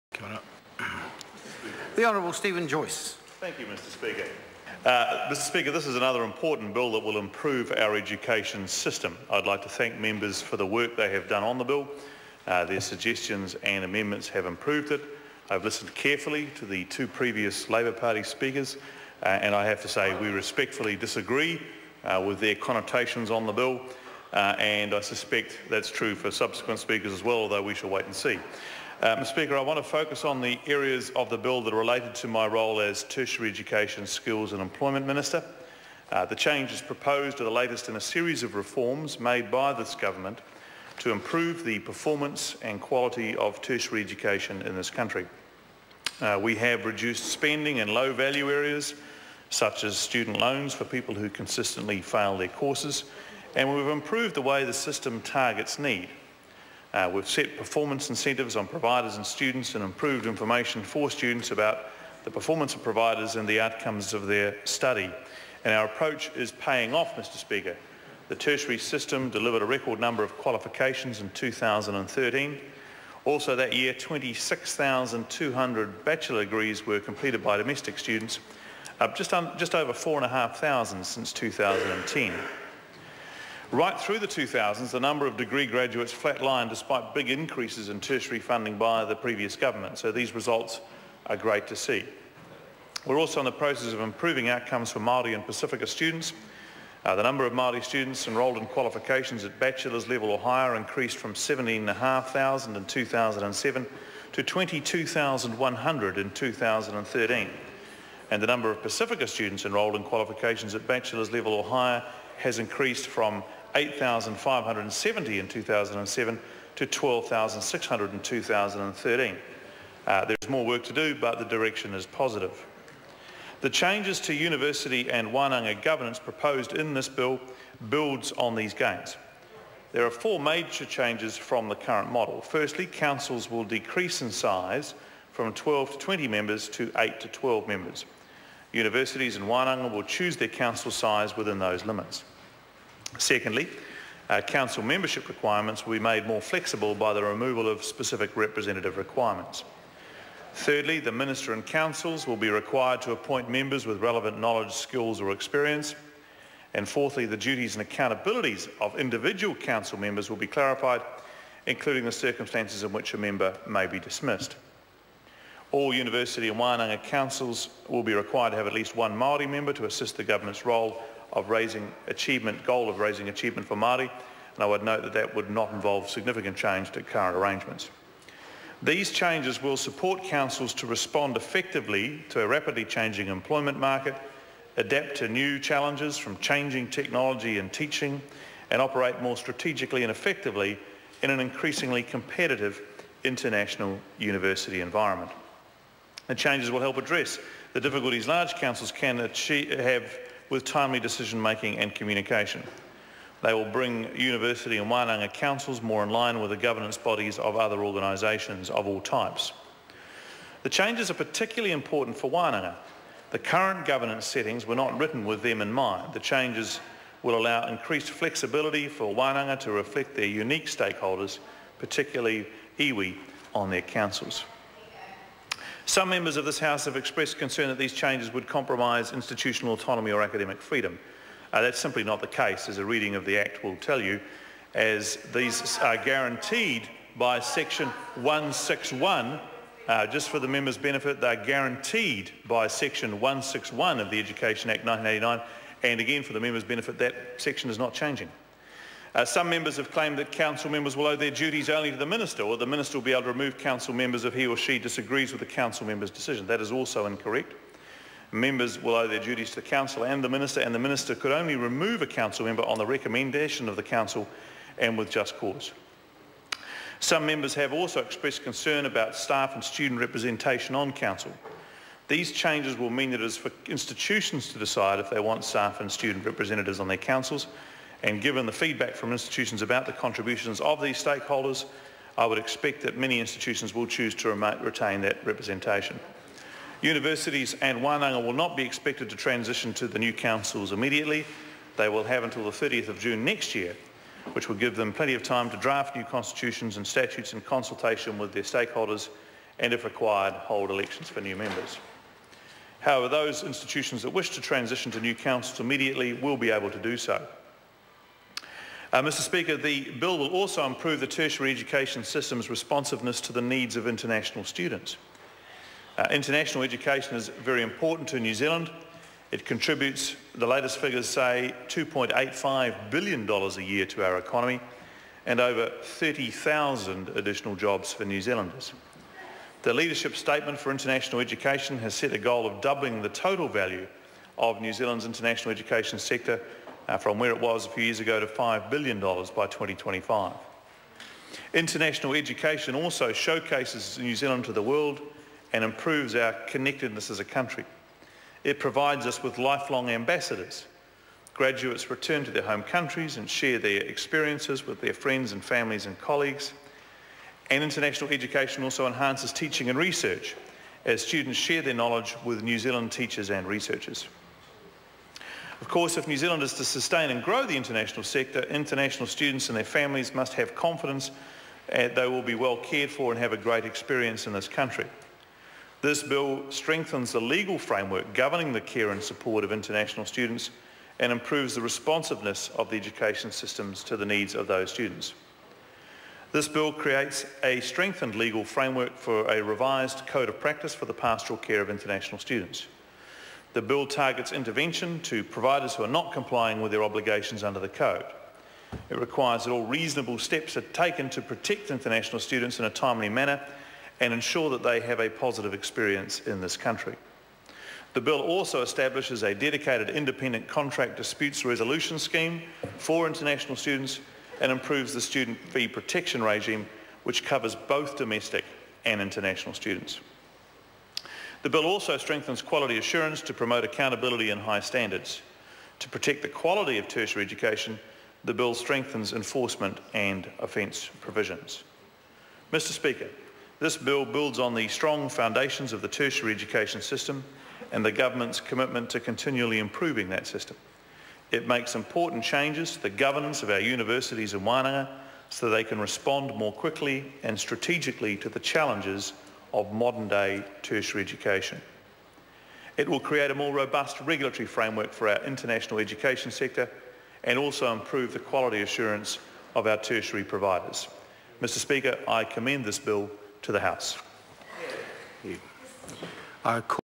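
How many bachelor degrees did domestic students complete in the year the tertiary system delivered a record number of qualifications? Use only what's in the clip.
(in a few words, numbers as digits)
26,200.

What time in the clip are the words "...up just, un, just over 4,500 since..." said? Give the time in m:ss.
1:18.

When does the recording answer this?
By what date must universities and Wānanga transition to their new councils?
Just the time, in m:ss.
4:52.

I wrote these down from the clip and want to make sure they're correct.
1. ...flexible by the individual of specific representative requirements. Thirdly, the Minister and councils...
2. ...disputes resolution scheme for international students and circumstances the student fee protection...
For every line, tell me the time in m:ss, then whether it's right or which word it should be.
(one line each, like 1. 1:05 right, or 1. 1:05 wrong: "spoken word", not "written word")
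1. 2:26 wrong: "removal", not "individual"
2. 6:50 wrong: "improves", not "circumstances".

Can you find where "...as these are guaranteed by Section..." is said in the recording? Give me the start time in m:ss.
3:54.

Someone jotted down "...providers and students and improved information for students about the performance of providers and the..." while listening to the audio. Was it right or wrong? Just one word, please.
right.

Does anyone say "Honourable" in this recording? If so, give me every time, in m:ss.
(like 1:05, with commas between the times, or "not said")
0:02.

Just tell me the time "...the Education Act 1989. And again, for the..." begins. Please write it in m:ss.
4:04.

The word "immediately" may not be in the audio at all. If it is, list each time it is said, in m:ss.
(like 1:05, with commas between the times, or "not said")
4:50, 5:05.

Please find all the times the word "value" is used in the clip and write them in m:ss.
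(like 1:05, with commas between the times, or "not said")
0:48, 5:33.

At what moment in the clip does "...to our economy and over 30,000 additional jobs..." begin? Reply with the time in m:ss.
5:23.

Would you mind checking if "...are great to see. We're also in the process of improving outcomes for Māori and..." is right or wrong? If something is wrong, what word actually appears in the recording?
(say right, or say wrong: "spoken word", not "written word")
right.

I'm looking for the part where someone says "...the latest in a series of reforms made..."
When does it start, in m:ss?
0:37.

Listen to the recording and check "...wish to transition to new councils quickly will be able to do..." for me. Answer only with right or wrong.
wrong.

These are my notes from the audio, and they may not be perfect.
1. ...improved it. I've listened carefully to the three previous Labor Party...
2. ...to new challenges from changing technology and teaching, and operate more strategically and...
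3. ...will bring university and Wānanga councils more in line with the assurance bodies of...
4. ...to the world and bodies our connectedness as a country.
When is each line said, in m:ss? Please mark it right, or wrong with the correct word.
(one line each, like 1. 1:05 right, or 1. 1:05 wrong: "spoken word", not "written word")
1. 0:14 wrong: "two", not "three"
2. 3:05 right
3. 3:23 wrong: "governance", not "assurance"
4. 5:44 wrong: "improves", not "bodies".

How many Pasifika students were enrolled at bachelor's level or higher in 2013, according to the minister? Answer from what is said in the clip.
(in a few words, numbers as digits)
12,600.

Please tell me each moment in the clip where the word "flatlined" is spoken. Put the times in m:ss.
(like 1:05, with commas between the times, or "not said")
1:26.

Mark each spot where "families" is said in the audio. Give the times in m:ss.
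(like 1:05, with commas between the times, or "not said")
5:55, 6:09.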